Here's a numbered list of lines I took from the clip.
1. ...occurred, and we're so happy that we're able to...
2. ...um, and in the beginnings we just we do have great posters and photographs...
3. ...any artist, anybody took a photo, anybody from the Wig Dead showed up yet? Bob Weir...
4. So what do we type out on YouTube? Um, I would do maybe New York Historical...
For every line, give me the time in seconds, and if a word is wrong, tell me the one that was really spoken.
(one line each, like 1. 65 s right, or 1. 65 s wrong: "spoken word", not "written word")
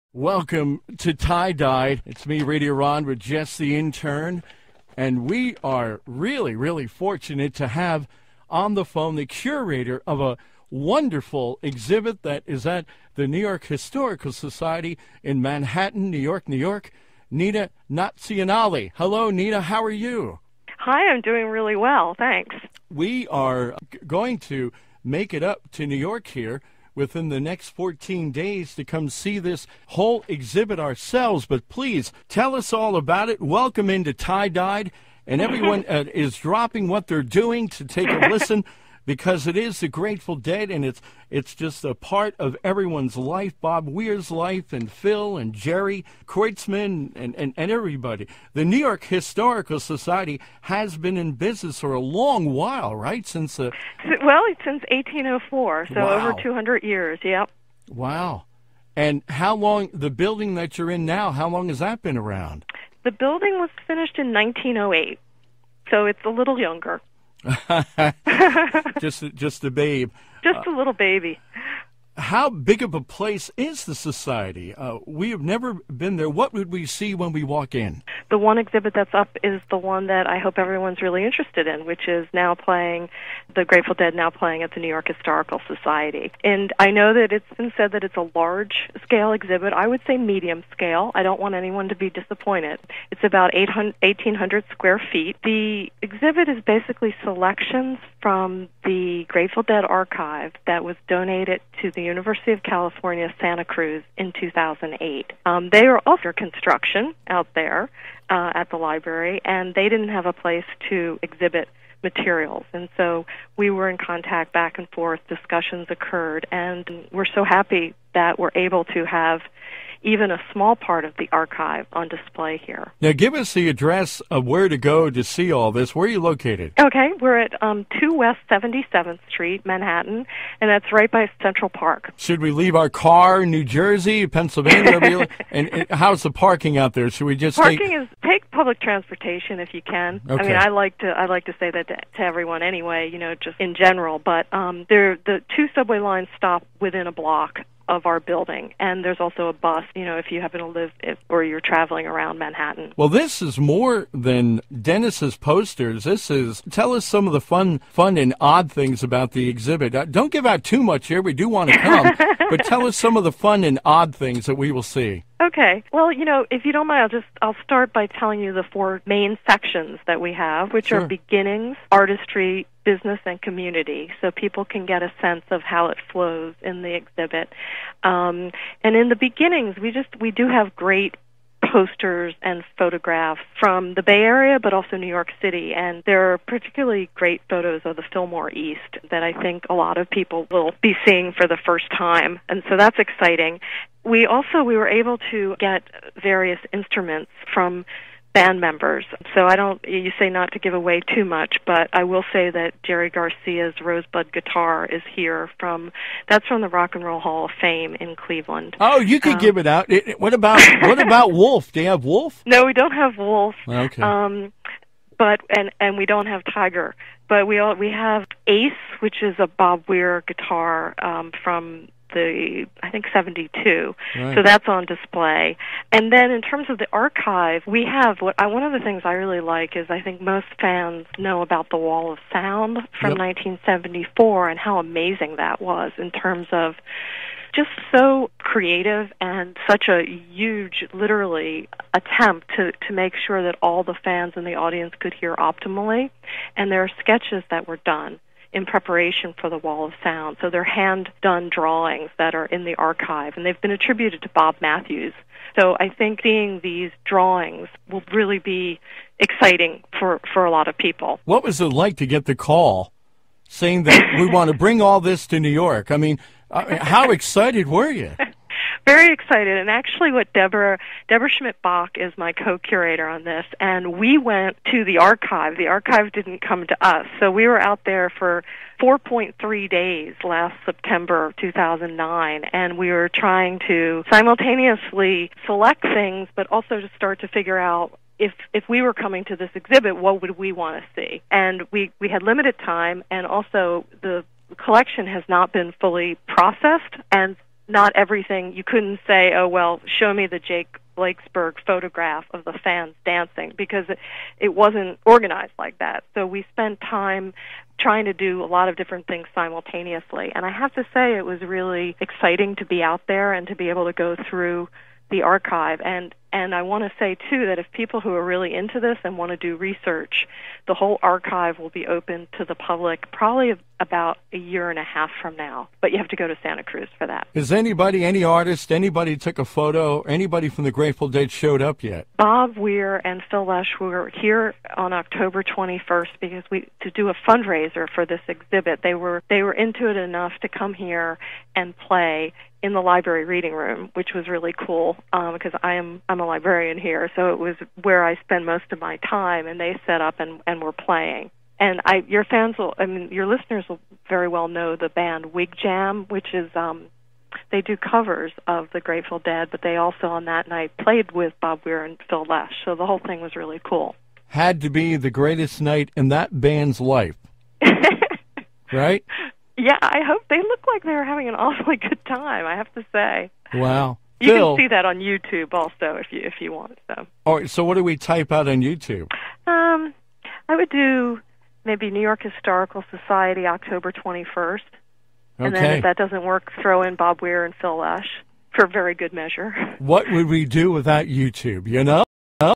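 1. 115 s right
2. 178 s right
3. 328 s wrong: "Grateful", not "Wig"
4. 377 s right.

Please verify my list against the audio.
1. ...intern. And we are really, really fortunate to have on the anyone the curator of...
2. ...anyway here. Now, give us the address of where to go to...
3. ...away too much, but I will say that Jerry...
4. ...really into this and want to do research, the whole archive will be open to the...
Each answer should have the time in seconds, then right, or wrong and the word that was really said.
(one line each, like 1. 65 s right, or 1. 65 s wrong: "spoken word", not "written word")
1. 3 s wrong: "phone", not "anyone"
2. 122 s wrong: "display", not "anyway"
3. 200 s right
4. 318 s right.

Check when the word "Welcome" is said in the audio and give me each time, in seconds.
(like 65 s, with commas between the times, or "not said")
0 s, 33 s.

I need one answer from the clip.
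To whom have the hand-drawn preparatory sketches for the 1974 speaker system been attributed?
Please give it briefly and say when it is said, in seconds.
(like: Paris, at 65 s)
Bob Matthews, at 254 s.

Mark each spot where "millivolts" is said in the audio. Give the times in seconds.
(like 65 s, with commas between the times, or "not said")
not said.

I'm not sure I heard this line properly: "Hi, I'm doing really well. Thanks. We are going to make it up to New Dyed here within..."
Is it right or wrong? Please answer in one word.
wrong.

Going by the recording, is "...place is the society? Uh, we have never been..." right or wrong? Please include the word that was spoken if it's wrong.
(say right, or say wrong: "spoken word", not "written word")
right.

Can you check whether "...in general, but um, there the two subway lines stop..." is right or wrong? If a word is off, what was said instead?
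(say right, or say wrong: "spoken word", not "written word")
right.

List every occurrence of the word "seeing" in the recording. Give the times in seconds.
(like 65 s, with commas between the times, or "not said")
191 s, 256 s.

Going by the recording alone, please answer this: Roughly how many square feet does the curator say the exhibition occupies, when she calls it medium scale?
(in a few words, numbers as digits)
1,800.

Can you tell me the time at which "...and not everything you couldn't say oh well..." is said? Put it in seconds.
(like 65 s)
297 s.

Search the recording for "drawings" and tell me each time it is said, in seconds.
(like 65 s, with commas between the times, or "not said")
251 s, 257 s.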